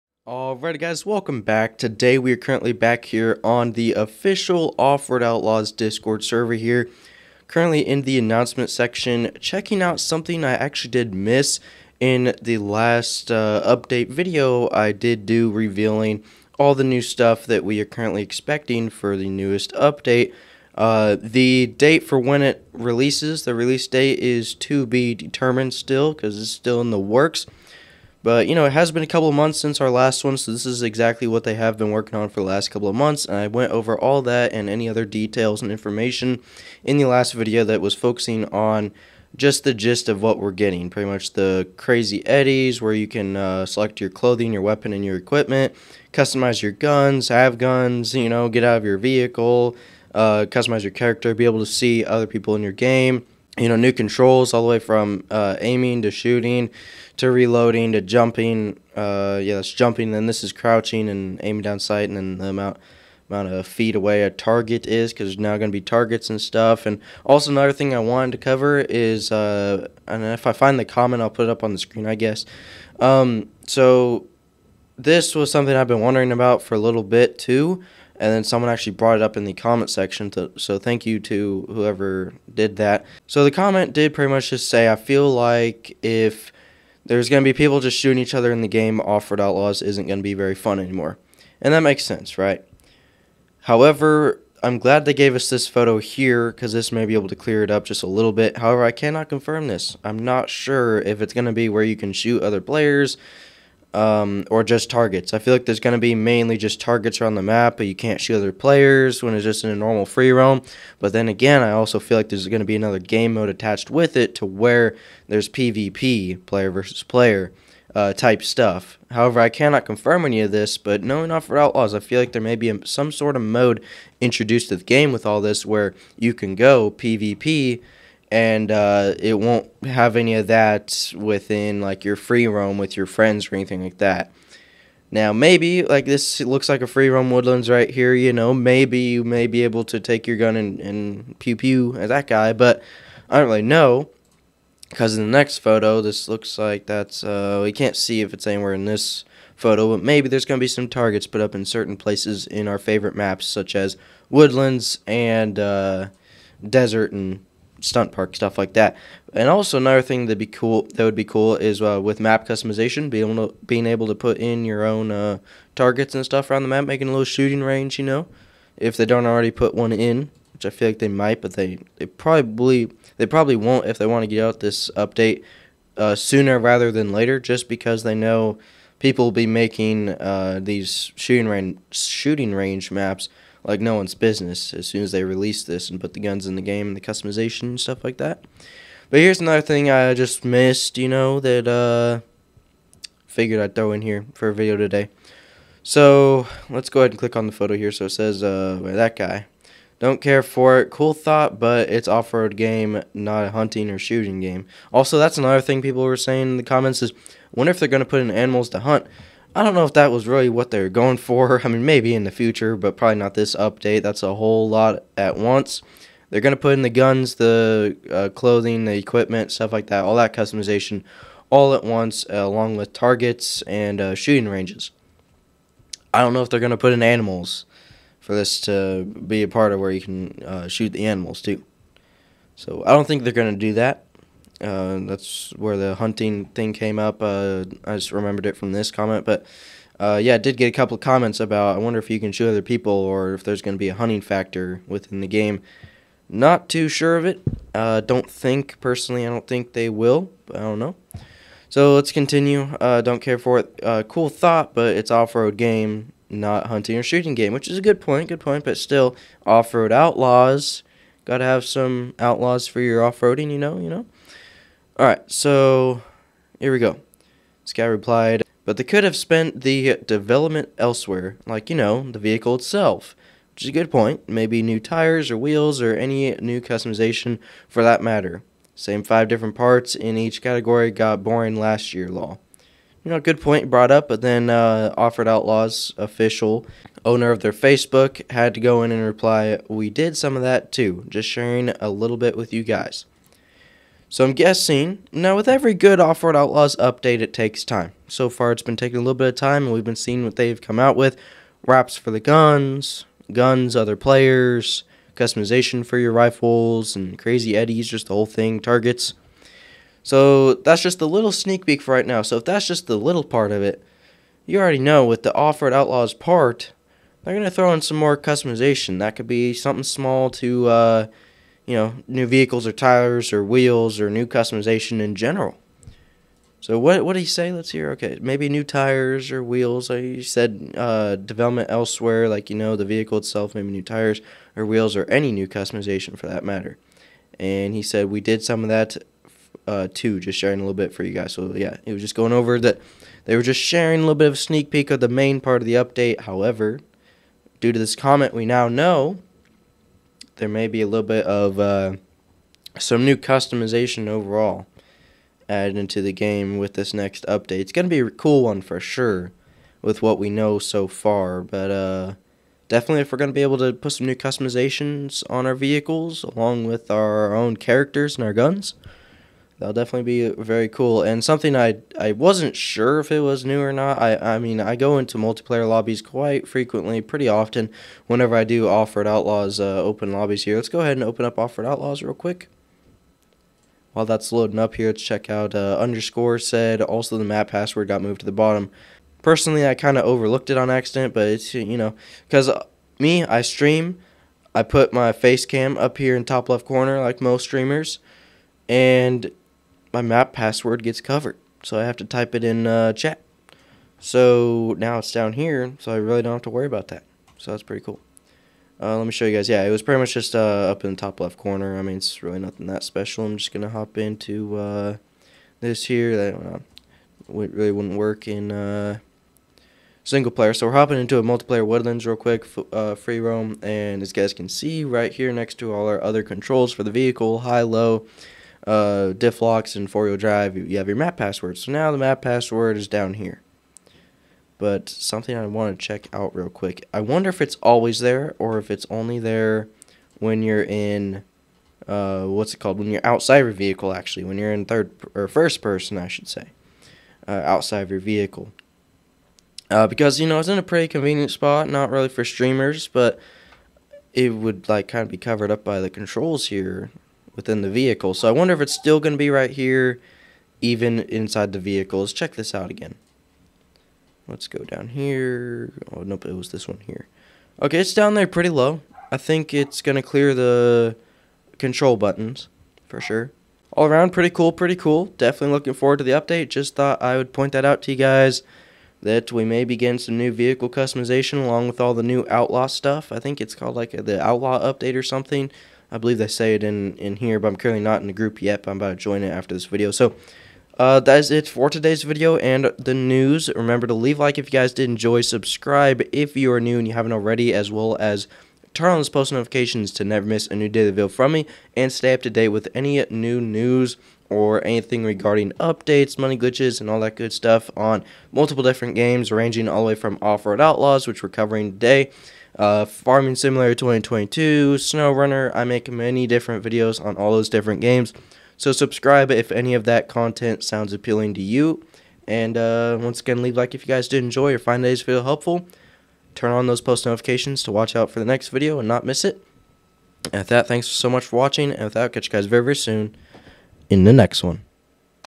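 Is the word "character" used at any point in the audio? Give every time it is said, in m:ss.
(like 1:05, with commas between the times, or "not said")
0:50, 6:07.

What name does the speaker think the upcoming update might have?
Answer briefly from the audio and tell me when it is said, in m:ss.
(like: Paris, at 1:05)
Outlaw update, at 8:04.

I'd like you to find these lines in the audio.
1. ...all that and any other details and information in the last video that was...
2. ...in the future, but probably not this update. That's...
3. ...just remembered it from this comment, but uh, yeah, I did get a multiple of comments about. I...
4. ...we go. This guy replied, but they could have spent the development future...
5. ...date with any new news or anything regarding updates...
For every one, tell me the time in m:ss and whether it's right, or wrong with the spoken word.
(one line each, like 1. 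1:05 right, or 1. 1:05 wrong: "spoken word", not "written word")
1. 0:33 right
2. 3:32 right
3. 3:57 wrong: "couple", not "multiple"
4. 4:26 wrong: "elsewhere", not "future"
5. 8:22 right.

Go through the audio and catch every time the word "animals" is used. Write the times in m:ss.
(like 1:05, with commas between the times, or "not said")
3:28, 3:47, 3:51.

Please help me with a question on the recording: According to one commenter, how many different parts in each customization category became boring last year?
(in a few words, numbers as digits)
5.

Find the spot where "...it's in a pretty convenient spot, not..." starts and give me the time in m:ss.
7:30.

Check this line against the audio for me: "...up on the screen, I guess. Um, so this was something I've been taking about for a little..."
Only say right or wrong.
wrong.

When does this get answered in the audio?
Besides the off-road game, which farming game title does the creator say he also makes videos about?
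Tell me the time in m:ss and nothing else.
8:32.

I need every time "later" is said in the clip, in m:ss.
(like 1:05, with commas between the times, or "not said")
2:57.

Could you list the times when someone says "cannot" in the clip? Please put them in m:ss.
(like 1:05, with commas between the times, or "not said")
1:38, 1:59.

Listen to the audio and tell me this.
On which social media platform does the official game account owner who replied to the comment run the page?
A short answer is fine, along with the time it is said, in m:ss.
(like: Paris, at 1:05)
Facebook, at 4:47.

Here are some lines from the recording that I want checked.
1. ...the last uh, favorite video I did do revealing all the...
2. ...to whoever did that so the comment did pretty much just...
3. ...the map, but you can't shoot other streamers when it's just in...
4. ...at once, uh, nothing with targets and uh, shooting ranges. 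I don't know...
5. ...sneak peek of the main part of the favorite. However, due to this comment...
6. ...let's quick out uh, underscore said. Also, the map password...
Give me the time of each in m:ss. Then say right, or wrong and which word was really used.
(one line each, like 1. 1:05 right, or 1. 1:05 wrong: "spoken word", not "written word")
1. 0:12 wrong: "update", not "favorite"
2. 1:21 right
3. 1:47 wrong: "players", not "streamers"
4. 3:41 wrong: "along", not "nothing"
5. 5:44 wrong: "update", not "favorite"
6. 6:24 wrong: "check", not "quick".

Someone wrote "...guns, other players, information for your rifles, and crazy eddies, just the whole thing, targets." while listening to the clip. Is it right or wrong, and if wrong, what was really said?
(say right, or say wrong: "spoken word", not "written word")
wrong: "customization", not "information".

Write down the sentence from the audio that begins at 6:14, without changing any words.
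I I mean I go into multiplayer lobbies quite frequently, pretty often.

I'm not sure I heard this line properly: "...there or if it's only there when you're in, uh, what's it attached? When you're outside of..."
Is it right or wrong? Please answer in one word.
wrong.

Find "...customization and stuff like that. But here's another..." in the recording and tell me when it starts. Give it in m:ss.
3:07.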